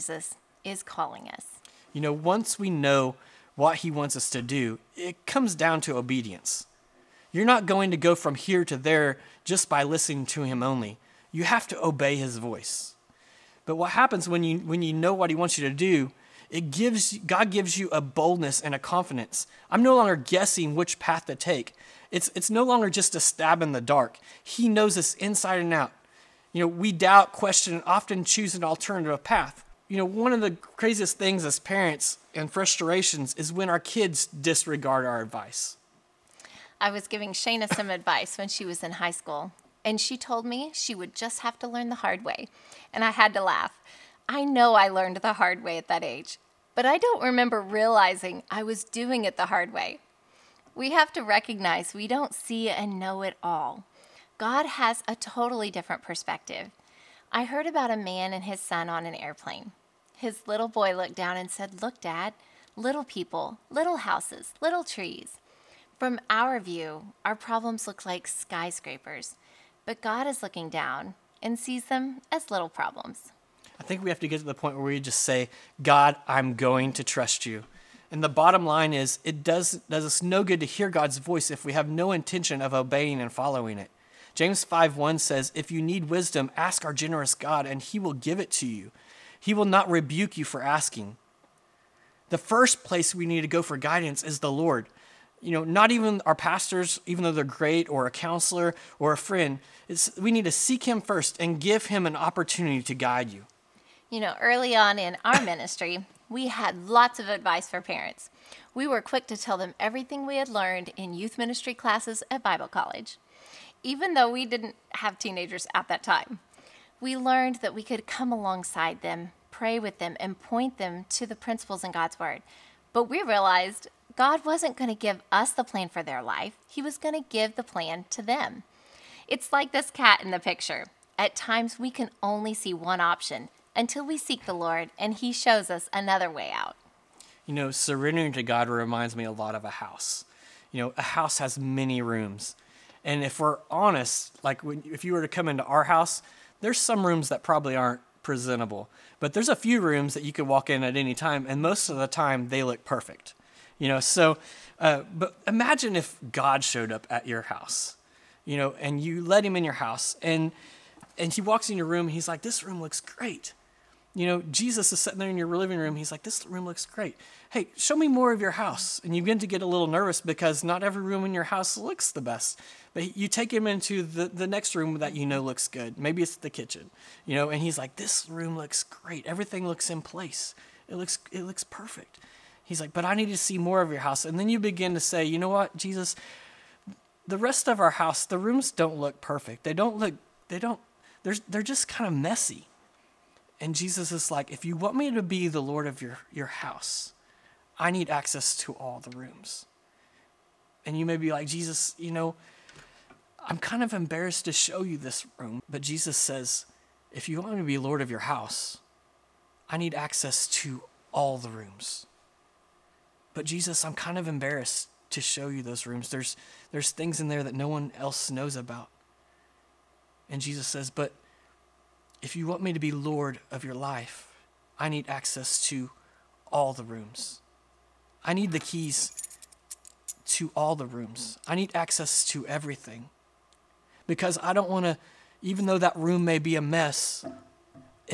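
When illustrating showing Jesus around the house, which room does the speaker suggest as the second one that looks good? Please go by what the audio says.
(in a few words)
the kitchen.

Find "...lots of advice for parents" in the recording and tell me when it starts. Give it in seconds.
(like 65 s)
106 s.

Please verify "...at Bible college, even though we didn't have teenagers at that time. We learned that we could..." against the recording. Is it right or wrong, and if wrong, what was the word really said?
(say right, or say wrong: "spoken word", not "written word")
right.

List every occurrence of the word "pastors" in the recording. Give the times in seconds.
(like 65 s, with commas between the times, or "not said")
96 s.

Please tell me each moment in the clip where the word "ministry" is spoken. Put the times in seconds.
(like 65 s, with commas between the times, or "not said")
105 s, 111 s.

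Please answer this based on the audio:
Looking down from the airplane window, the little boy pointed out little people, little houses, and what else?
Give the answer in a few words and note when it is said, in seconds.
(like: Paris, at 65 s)
little trees, at 64 s.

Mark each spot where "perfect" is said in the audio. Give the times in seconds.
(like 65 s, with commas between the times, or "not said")
152 s, 181 s, 189 s.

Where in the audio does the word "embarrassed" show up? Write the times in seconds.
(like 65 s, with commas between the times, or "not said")
203 s, 214 s.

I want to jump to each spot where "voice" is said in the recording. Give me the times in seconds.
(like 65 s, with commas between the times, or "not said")
12 s, 81 s.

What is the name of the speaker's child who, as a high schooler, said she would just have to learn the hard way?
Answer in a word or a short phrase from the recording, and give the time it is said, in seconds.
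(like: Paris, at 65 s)
Shana, at 37 s.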